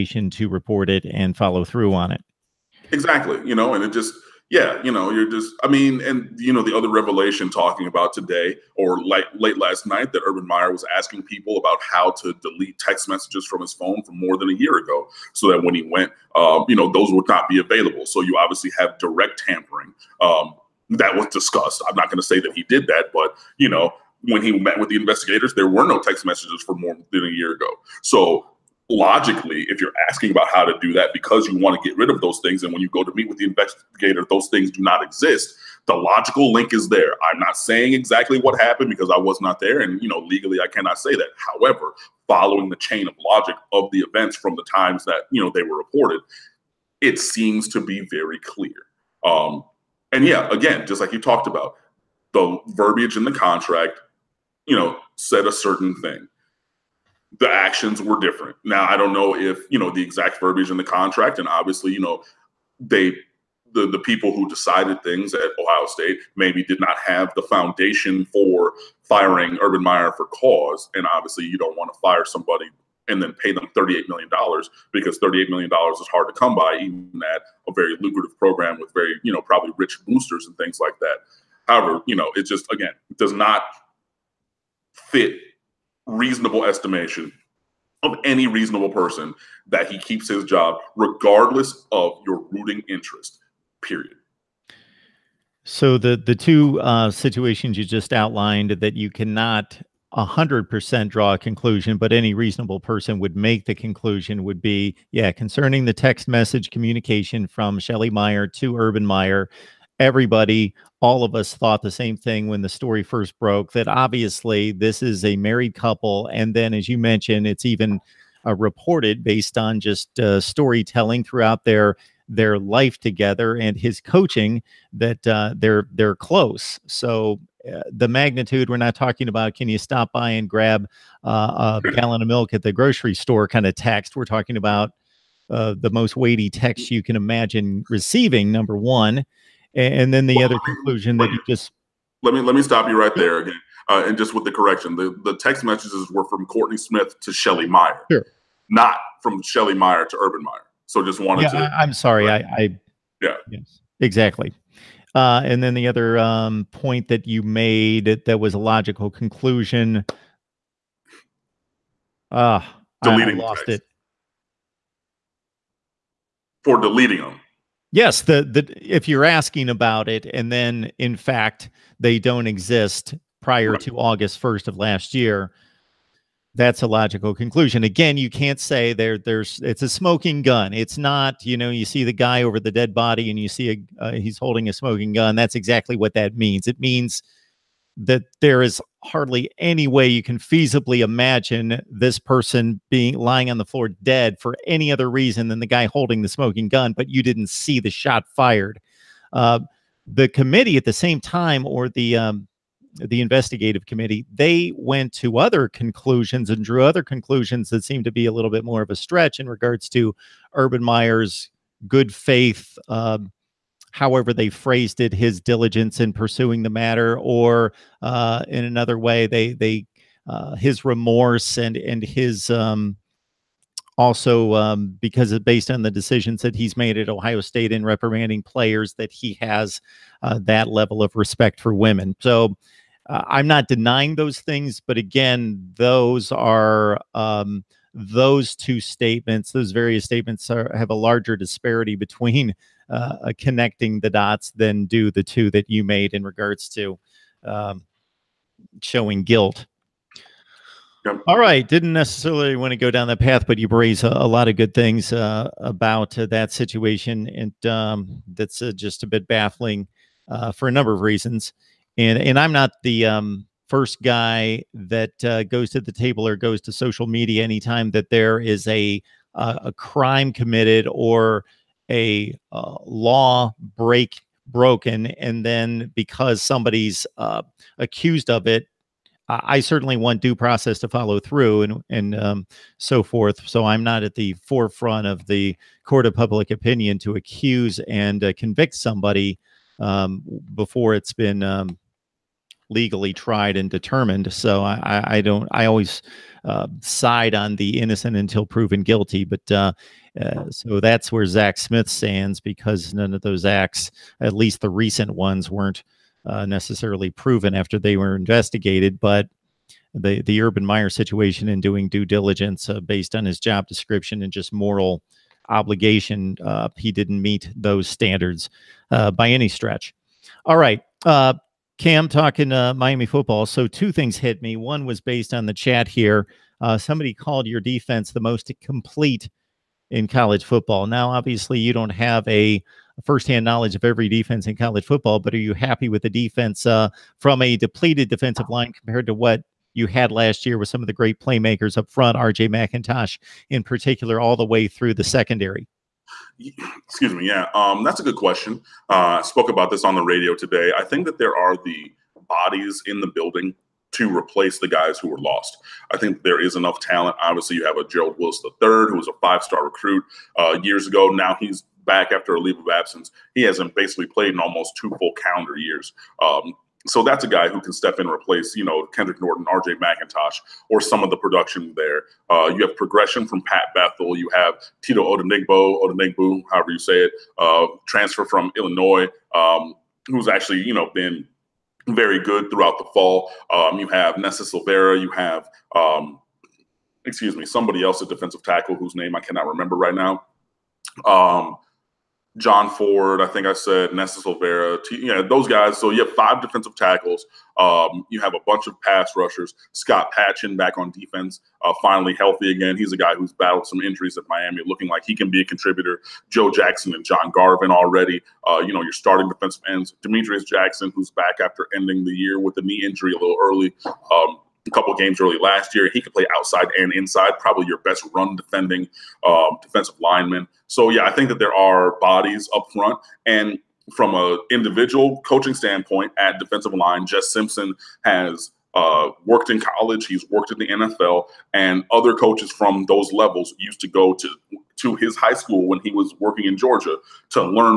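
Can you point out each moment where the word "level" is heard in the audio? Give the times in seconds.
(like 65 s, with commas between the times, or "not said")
230 s, 433 s.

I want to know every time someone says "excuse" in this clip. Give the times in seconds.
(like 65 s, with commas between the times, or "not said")
346 s, 387 s.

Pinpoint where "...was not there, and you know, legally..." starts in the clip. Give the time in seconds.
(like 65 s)
39 s.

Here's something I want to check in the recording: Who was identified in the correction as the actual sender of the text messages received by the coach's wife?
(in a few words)
Courtney Smith.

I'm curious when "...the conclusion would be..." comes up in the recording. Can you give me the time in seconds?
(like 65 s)
103 s.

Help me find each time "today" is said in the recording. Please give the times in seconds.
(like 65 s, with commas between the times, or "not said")
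8 s, 350 s.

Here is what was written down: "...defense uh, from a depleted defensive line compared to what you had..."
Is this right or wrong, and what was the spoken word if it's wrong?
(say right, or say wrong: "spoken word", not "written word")
right.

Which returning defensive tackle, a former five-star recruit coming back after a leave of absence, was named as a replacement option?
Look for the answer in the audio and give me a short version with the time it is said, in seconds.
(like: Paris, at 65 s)
Gerald Willis III, at 357 s.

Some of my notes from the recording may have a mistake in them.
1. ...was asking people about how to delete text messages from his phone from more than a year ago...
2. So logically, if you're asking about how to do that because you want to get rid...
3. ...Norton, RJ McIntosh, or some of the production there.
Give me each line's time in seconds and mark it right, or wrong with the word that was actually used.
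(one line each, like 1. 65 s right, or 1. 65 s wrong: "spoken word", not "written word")
1. 10 s right
2. 28 s right
3. 369 s right.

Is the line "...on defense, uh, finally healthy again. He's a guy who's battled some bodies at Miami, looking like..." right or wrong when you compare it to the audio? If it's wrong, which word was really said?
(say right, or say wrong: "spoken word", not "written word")
wrong: "injuries", not "bodies".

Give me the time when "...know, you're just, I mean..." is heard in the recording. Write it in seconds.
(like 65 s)
4 s.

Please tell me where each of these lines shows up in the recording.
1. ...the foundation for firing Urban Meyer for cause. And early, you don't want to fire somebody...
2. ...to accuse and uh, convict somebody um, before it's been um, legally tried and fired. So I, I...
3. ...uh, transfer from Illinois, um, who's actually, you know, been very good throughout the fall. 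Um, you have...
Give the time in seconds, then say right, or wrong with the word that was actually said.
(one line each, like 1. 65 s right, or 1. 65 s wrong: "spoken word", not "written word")
1. 67 s wrong: "obviously", not "early"
2. 286 s wrong: "determined", not "fired"
3. 377 s right.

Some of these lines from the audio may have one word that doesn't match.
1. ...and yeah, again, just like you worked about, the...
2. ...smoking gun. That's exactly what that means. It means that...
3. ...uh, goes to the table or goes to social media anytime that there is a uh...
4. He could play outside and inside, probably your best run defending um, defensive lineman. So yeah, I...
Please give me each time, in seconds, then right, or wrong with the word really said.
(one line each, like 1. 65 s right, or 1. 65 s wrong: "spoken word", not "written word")
1. 50 s wrong: "talked", not "worked"
2. 184 s right
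3. 265 s right
4. 415 s right.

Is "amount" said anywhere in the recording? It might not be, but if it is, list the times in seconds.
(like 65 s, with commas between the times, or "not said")
not said.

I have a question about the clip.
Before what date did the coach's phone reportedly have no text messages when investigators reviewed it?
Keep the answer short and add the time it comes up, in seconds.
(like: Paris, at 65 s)
August 1st, at 173 s.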